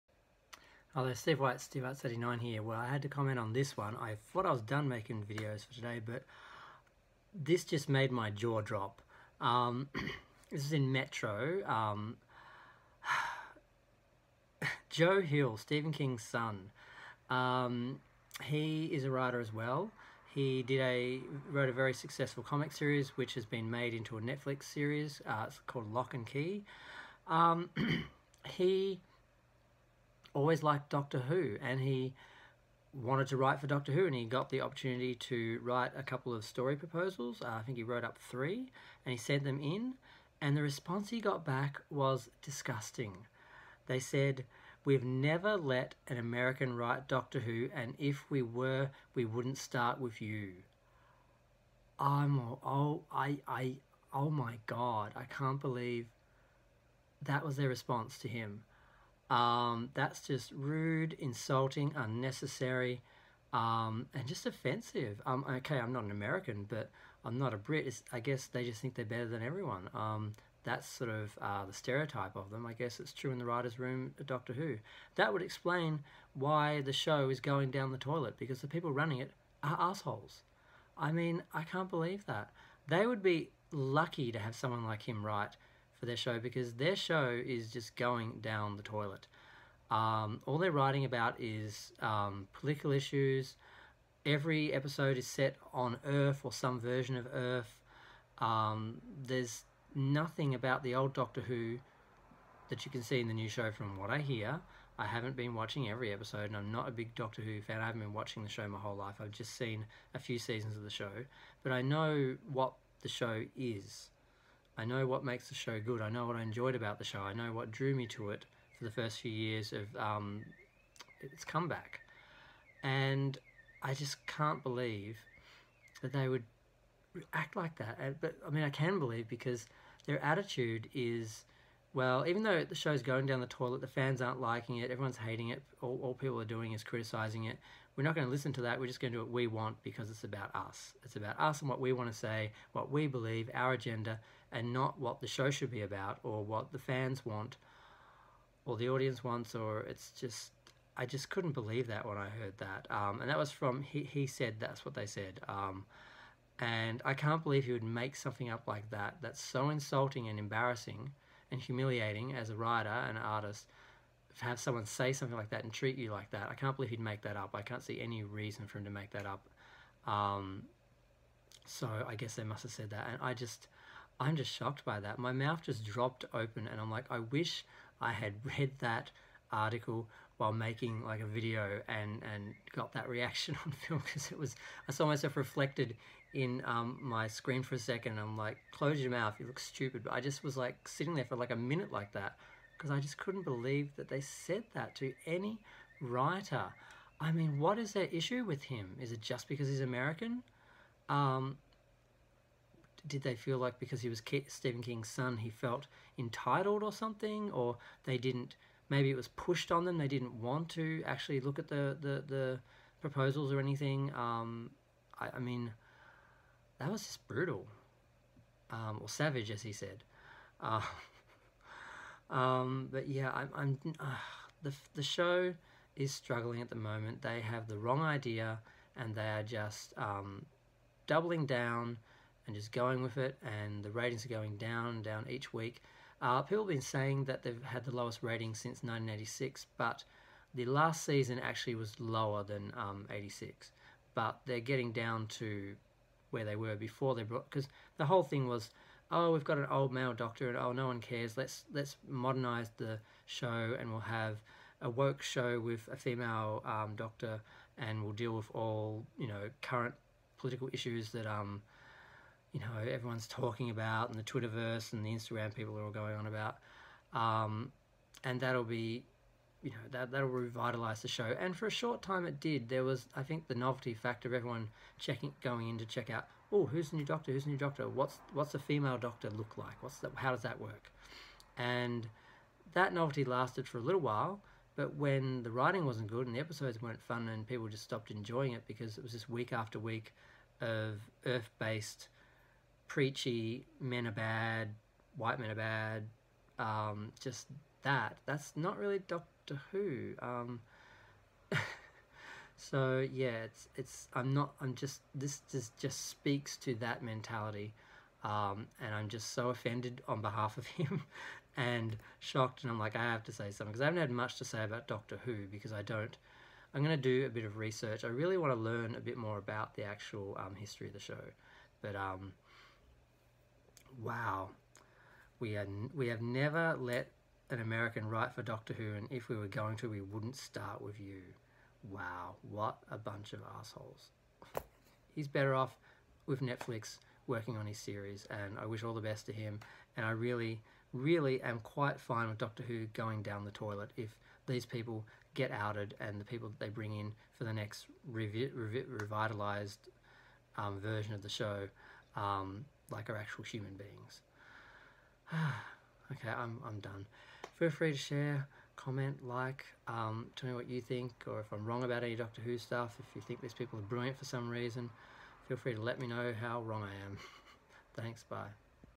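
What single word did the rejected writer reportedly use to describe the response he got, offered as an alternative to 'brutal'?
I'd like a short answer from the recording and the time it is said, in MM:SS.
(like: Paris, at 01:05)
Savage, at 03:39.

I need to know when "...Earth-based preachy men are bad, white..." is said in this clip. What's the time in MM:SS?
04:51.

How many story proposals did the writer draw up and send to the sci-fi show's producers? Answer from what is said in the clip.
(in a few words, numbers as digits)
3.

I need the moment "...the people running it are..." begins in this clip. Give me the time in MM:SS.
01:18.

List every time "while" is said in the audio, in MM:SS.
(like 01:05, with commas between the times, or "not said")
03:00, 04:44.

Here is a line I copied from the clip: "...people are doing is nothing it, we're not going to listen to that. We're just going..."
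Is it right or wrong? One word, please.
wrong.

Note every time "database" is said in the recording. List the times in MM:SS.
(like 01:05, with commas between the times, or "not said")
not said.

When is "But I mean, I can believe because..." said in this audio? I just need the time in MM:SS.
02:08.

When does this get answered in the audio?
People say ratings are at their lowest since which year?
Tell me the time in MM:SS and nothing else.
03:58.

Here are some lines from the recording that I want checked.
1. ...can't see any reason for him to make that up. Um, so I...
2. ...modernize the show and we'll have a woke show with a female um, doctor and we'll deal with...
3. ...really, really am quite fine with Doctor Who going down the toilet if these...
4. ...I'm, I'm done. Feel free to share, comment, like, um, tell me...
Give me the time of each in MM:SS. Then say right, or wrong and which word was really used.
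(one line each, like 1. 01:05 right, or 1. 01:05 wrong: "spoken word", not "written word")
1. 02:47 right
2. 04:12 right
3. 05:40 right
4. 05:56 right.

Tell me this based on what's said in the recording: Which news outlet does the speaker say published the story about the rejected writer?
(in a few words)
Metro.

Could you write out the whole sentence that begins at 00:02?
Well, I had to comment on this one.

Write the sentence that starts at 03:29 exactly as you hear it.
They didn't want to actually look at the, the, the proposals or anything.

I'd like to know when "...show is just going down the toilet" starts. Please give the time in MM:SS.
01:26.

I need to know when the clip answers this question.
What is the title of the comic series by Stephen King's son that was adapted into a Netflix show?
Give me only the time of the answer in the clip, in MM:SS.
00:25.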